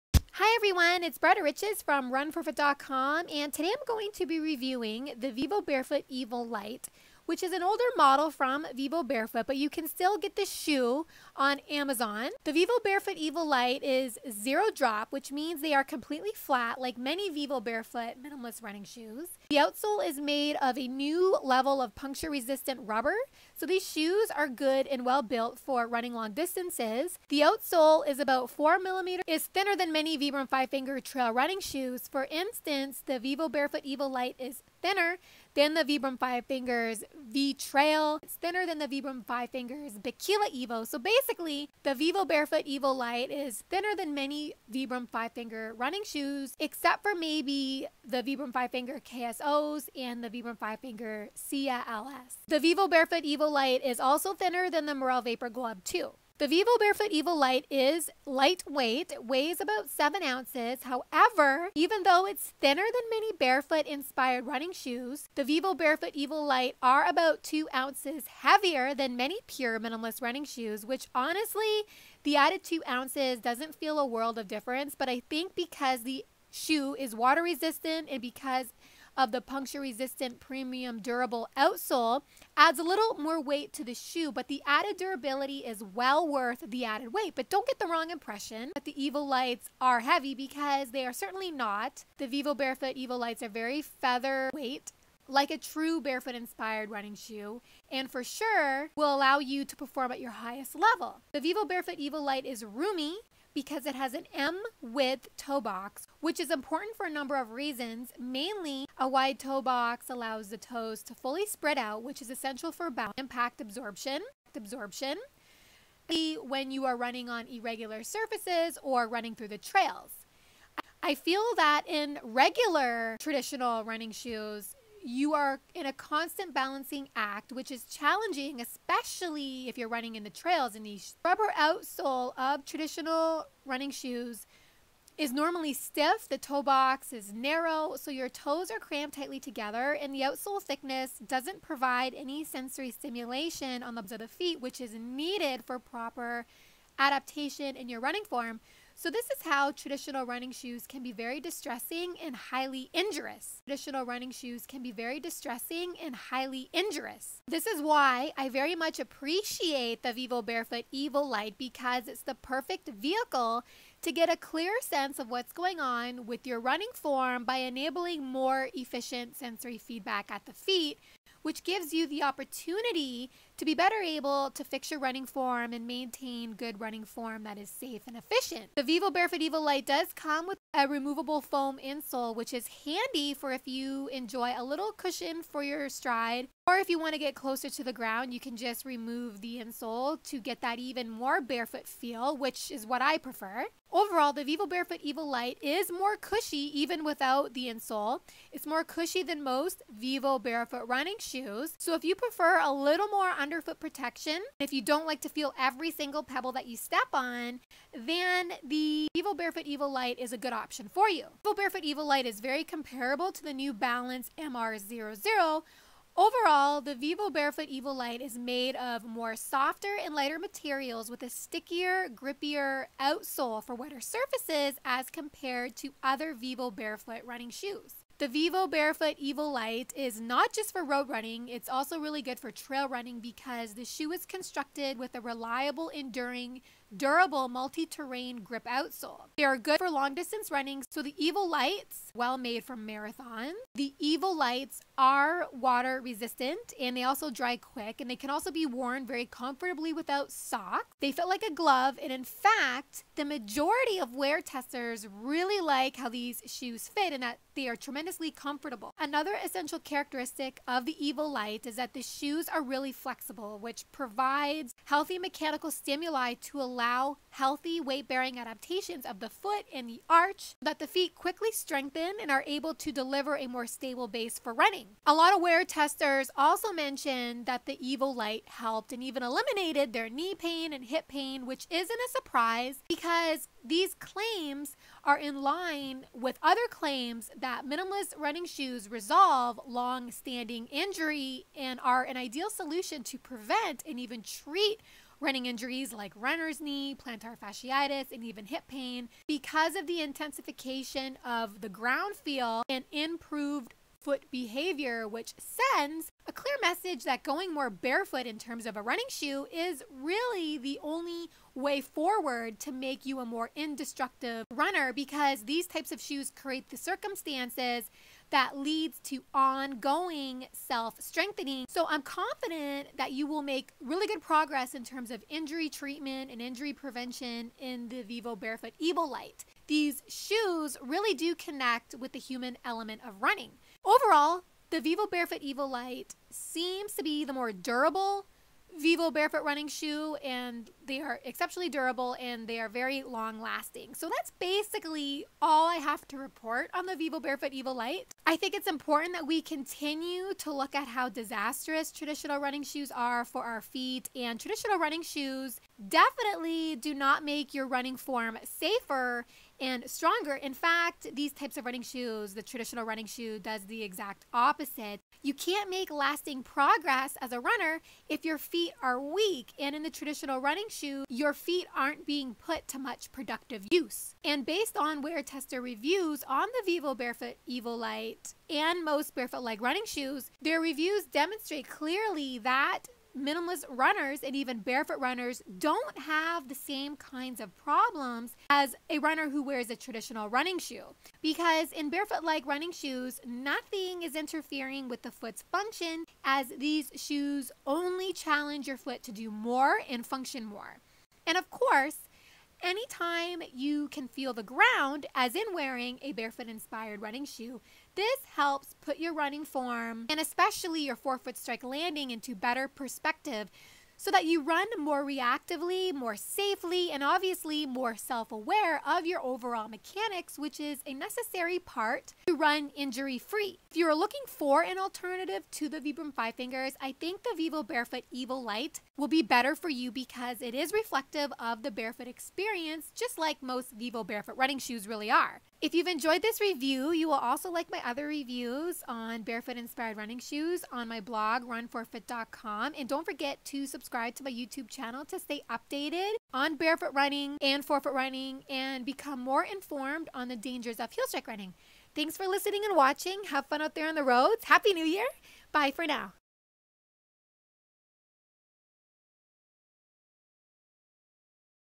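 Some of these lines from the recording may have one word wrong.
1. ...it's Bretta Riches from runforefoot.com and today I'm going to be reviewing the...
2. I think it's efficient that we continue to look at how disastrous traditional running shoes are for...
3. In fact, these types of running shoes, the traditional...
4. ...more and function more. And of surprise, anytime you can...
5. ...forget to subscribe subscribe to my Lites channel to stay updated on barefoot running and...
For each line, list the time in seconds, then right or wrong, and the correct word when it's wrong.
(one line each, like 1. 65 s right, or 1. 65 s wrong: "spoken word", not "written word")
1. 1 s right
2. 348 s wrong: "important", not "efficient"
3. 360 s right
4. 399 s wrong: "course", not "surprise"
5. 443 s wrong: "YouTube", not "Lites".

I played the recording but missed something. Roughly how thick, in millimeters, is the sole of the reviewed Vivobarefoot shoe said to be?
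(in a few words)
4 millimeters.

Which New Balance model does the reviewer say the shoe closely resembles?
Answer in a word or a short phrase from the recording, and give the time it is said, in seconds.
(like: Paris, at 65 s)
MR00, at 213 s.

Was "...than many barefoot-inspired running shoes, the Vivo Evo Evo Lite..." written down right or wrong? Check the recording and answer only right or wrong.
wrong.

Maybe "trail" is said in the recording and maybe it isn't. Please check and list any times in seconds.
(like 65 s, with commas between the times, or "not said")
30 s, 37 s, 119 s, 130 s, 232 s.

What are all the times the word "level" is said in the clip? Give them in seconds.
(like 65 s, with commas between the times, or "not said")
21 s, 100 s.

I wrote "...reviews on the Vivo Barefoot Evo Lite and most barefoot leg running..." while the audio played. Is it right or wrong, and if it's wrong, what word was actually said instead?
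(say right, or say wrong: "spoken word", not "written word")
right.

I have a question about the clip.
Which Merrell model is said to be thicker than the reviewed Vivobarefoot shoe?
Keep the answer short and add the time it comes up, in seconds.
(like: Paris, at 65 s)
Vapor Glove 2, at 54 s.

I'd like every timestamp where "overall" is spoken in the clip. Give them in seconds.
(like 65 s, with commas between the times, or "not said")
193 s, 216 s, 333 s, 419 s.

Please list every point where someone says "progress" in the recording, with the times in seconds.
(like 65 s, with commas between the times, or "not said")
324 s, 366 s.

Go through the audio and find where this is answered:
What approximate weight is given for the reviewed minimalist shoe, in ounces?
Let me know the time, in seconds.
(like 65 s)
59 s.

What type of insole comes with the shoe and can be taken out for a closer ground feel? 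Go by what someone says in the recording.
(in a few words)
foam insole.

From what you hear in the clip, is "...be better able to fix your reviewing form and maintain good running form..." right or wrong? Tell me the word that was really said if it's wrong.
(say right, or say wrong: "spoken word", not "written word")
wrong: "running", not "reviewing".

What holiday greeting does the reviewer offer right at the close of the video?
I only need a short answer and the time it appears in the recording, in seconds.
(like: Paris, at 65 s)
Happy New Year, at 454 s.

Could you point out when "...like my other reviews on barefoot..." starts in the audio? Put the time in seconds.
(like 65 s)
437 s.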